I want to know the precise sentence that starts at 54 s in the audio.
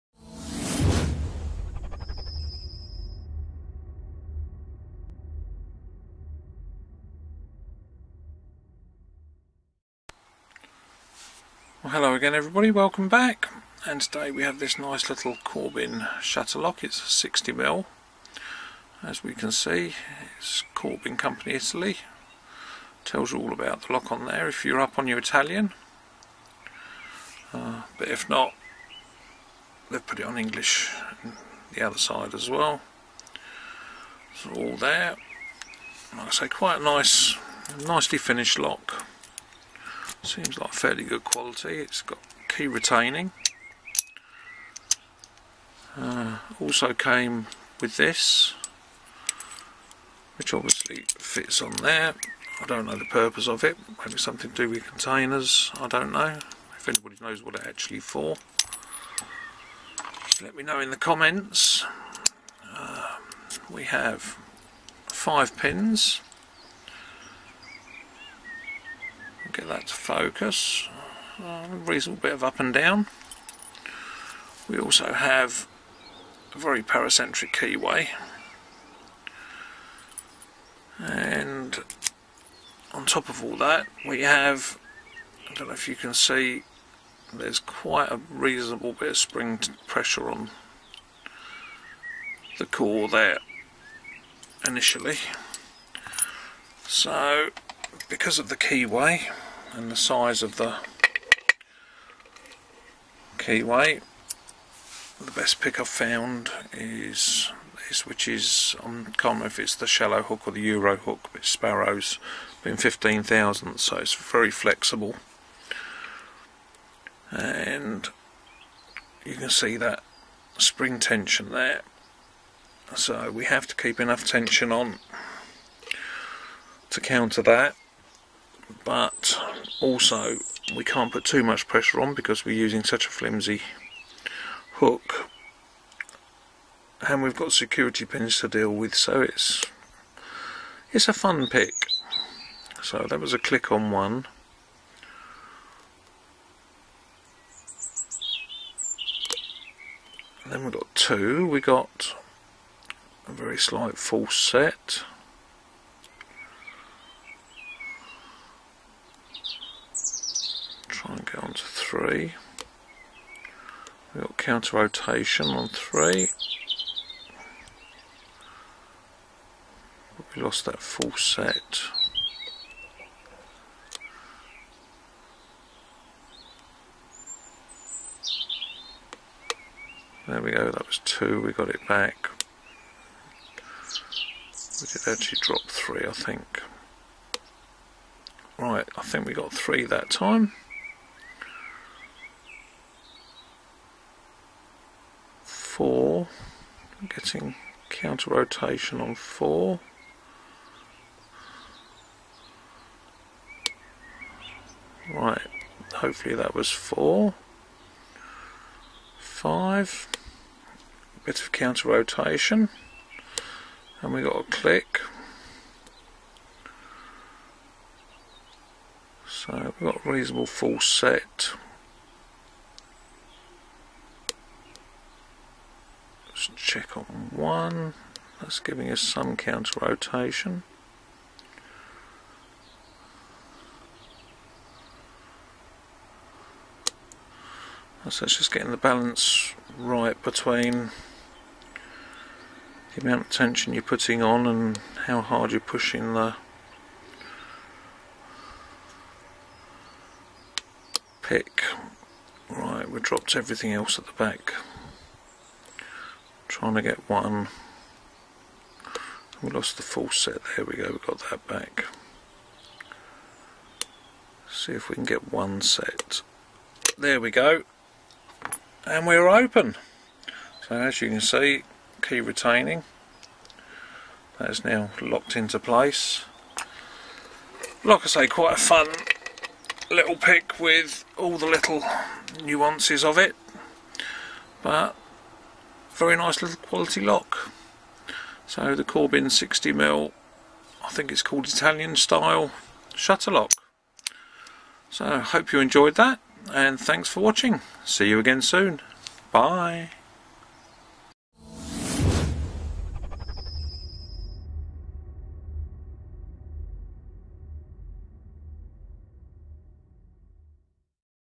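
Maybe something to do with containers.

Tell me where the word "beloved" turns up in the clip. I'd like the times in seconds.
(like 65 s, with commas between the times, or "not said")
not said.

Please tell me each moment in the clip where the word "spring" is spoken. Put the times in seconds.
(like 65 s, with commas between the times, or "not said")
89 s, 120 s.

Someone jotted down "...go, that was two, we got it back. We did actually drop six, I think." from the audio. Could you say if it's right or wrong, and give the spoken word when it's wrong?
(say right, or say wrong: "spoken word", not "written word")
wrong: "three", not "six".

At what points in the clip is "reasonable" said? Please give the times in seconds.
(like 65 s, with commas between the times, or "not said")
71 s, 88 s, 220 s.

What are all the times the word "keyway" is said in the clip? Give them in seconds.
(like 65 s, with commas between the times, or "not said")
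77 s, 98 s, 103 s.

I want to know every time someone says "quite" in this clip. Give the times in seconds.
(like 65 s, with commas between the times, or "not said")
36 s, 87 s, 278 s.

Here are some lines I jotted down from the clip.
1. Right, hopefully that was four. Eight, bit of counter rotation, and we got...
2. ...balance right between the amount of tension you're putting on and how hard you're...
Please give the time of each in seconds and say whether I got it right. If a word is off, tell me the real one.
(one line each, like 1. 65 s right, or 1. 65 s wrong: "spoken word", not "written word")
1. 205 s wrong: "Five", not "Eight"
2. 238 s right.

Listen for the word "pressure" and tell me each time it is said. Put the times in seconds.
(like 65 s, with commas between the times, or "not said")
89 s, 131 s.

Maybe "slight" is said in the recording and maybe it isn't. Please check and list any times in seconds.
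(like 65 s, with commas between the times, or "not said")
153 s.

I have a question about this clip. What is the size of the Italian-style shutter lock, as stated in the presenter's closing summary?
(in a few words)
60mm.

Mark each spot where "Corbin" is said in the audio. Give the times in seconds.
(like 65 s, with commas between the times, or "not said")
15 s, 20 s, 288 s.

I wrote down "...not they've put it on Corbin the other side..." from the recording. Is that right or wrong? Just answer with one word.
wrong.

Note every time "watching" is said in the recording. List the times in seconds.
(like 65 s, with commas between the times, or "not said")
297 s.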